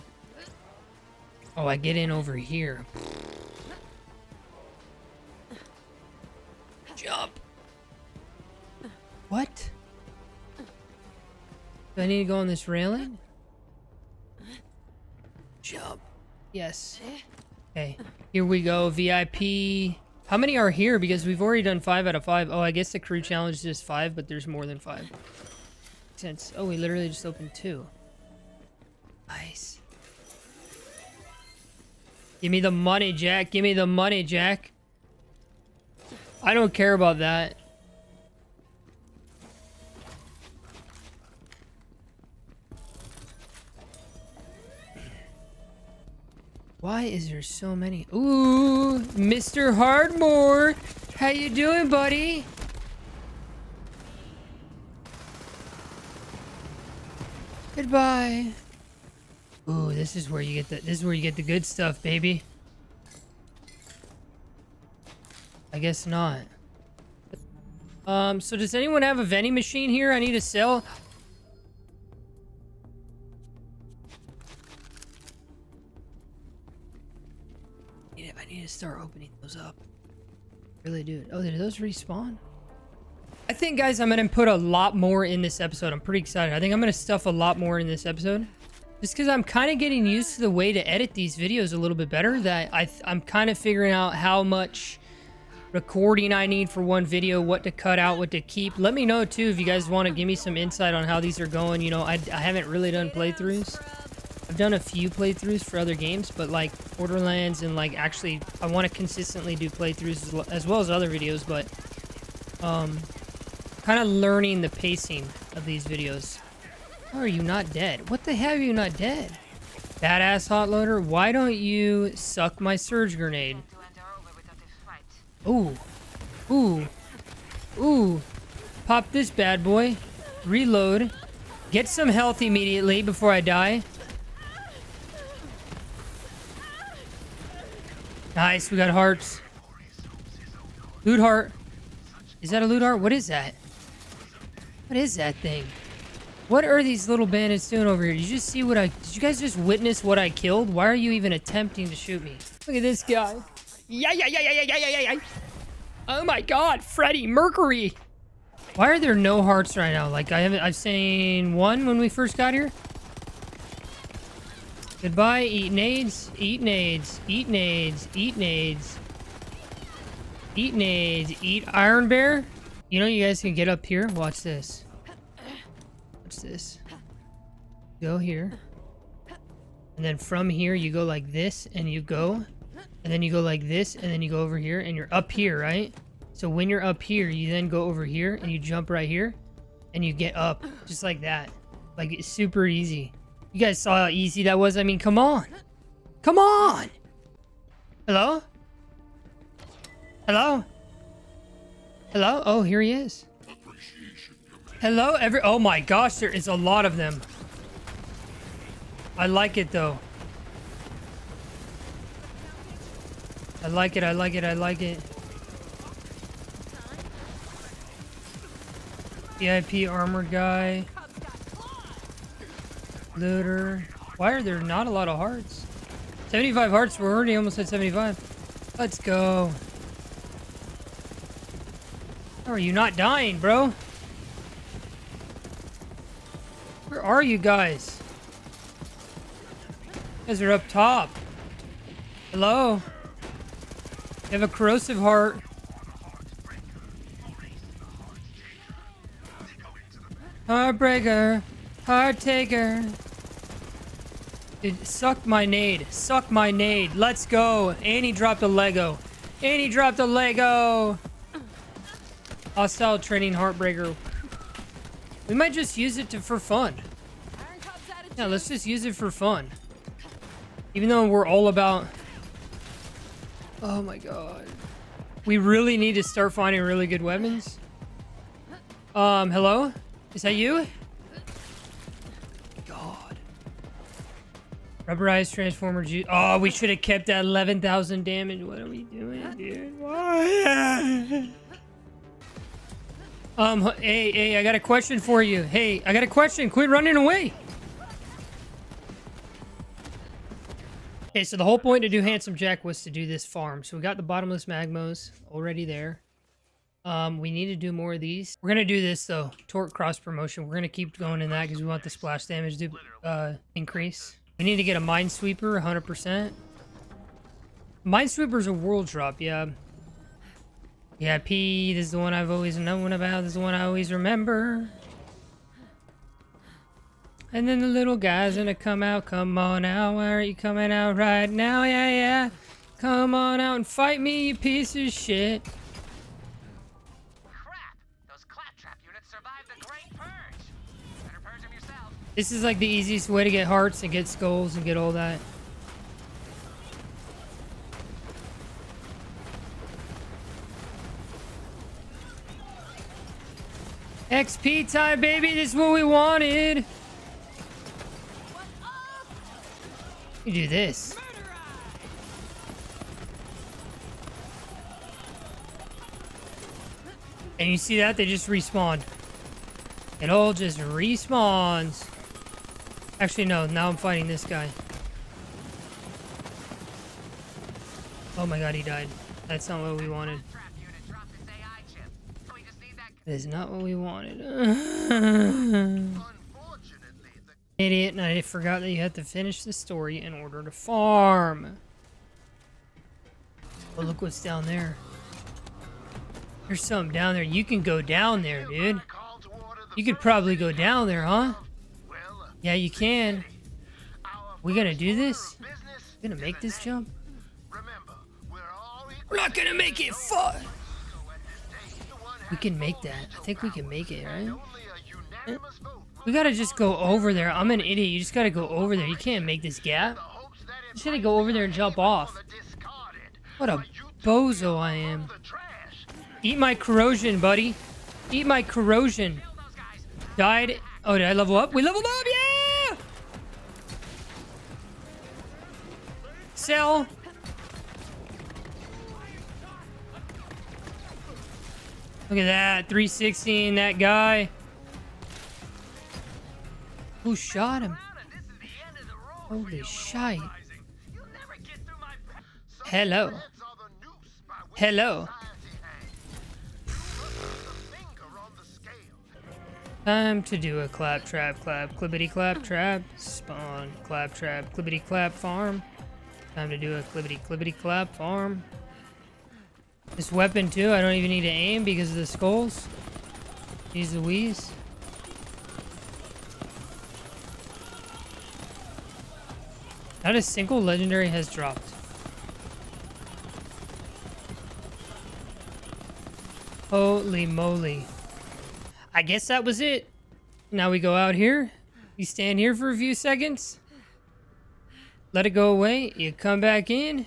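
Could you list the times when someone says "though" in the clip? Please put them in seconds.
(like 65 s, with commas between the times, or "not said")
209 s, 270 s, 309 s.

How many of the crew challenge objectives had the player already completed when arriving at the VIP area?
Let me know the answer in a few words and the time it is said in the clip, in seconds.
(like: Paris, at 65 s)
5 out of 5, at 21 s.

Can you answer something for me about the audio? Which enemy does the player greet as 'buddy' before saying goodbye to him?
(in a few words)
Mr. Hardmore.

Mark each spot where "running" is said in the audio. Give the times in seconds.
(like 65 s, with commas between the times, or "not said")
296 s.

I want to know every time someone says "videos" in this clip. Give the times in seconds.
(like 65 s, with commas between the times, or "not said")
91 s, 97 s, 111 s, 115 s.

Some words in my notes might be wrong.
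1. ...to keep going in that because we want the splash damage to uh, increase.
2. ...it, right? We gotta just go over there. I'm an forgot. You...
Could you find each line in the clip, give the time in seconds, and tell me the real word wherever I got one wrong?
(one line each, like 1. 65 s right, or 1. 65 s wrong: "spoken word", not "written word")
1. 310 s right
2. 413 s wrong: "idiot", not "forgot".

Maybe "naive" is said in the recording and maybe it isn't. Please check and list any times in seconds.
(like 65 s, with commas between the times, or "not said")
not said.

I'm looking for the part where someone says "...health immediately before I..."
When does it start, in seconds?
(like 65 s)
132 s.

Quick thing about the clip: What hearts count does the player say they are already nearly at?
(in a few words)
75.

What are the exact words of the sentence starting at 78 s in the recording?
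I need, I need to start opening those up.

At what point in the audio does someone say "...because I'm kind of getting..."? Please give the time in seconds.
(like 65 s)
89 s.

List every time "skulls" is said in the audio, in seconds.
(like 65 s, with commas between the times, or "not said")
344 s, 472 s.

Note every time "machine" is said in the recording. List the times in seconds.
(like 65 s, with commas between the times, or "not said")
69 s.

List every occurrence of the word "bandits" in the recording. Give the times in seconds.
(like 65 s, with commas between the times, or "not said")
147 s.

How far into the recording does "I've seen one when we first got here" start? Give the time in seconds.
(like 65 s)
160 s.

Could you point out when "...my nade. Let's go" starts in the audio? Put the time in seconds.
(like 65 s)
256 s.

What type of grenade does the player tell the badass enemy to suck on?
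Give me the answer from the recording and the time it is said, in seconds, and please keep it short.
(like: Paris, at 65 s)
Surge grenade, at 122 s.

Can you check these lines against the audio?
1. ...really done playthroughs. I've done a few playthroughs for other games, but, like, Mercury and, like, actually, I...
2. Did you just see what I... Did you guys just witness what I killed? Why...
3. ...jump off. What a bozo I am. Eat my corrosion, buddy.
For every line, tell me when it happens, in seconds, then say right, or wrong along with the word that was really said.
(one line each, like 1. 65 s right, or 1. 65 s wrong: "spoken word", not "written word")
1. 102 s wrong: "Borderlands", not "Mercury"
2. 148 s right
3. 421 s right.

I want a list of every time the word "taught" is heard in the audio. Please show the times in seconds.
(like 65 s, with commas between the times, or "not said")
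not said.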